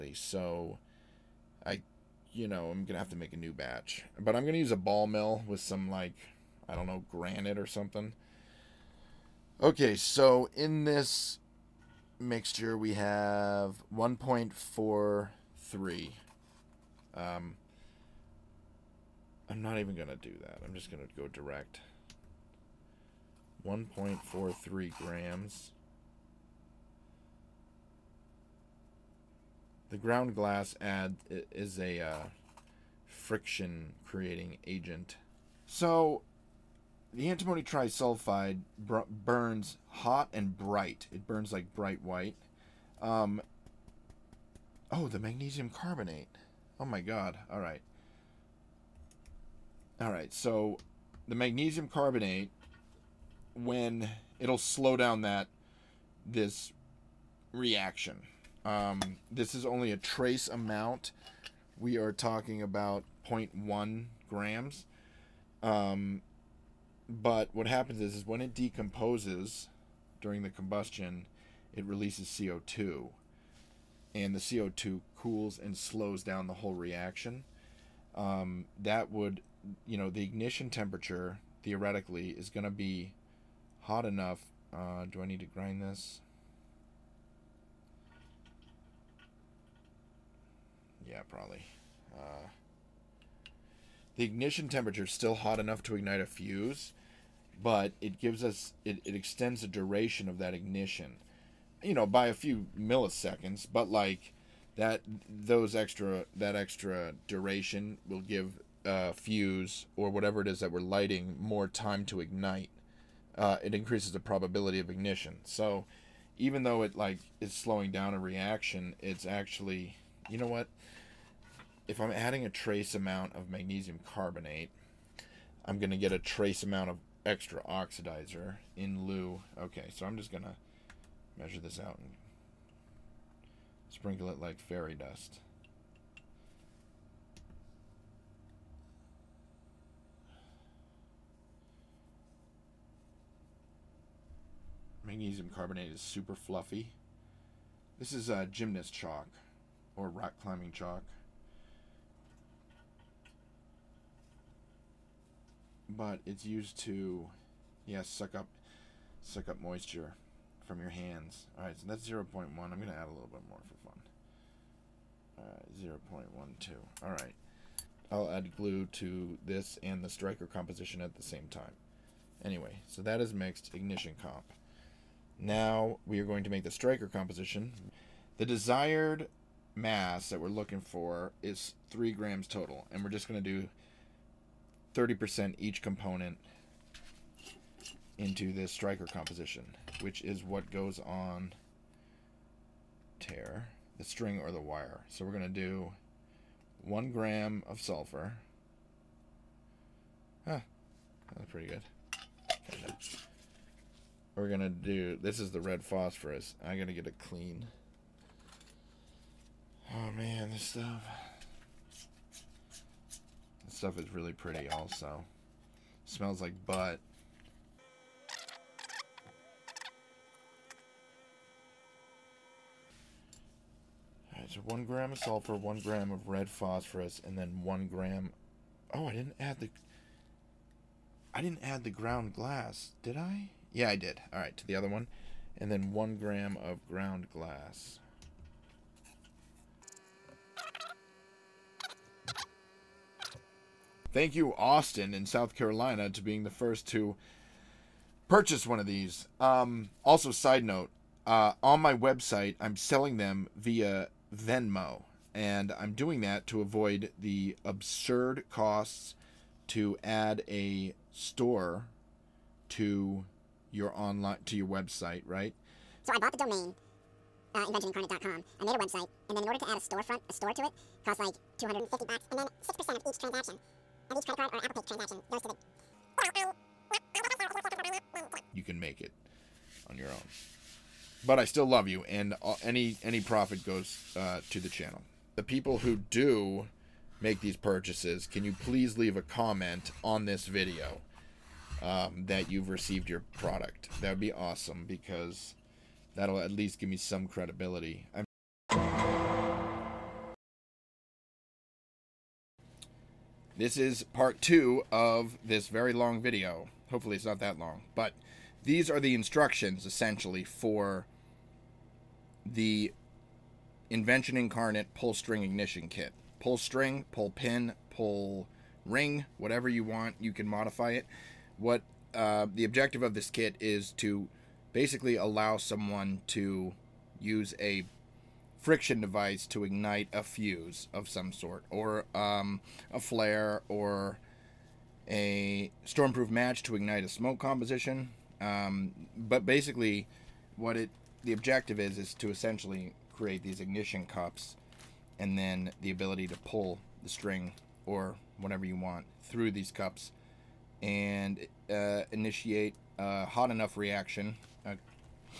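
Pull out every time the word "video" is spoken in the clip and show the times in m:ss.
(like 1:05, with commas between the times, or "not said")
4:50, 5:06.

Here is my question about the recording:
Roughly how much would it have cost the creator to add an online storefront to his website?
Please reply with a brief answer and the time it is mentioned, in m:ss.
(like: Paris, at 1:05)
$250, at 4:31.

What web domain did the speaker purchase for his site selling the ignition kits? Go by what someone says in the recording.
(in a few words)
inventionincarnate.com.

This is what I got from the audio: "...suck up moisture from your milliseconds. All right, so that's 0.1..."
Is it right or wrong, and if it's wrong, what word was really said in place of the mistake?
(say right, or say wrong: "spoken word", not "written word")
wrong: "hands", not "milliseconds".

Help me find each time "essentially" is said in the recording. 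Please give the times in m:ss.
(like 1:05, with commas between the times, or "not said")
5:09, 5:42.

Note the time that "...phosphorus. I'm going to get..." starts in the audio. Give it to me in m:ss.
3:25.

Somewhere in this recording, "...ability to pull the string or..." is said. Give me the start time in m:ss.
5:45.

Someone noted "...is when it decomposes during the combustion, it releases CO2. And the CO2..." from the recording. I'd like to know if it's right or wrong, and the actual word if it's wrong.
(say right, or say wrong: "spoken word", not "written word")
right.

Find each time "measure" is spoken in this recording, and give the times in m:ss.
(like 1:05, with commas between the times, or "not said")
2:11.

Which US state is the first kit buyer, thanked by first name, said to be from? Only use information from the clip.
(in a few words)
South Carolina.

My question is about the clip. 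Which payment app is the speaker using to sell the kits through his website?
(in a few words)
Venmo.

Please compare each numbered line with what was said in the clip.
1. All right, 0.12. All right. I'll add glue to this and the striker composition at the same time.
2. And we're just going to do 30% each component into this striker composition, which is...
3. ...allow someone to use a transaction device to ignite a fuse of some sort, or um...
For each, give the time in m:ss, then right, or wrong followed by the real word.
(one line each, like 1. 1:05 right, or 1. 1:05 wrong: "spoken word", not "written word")
1. 2:45 right
2. 3:02 right
3. 5:25 wrong: "friction", not "transaction".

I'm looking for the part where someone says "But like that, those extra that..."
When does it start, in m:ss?
1:43.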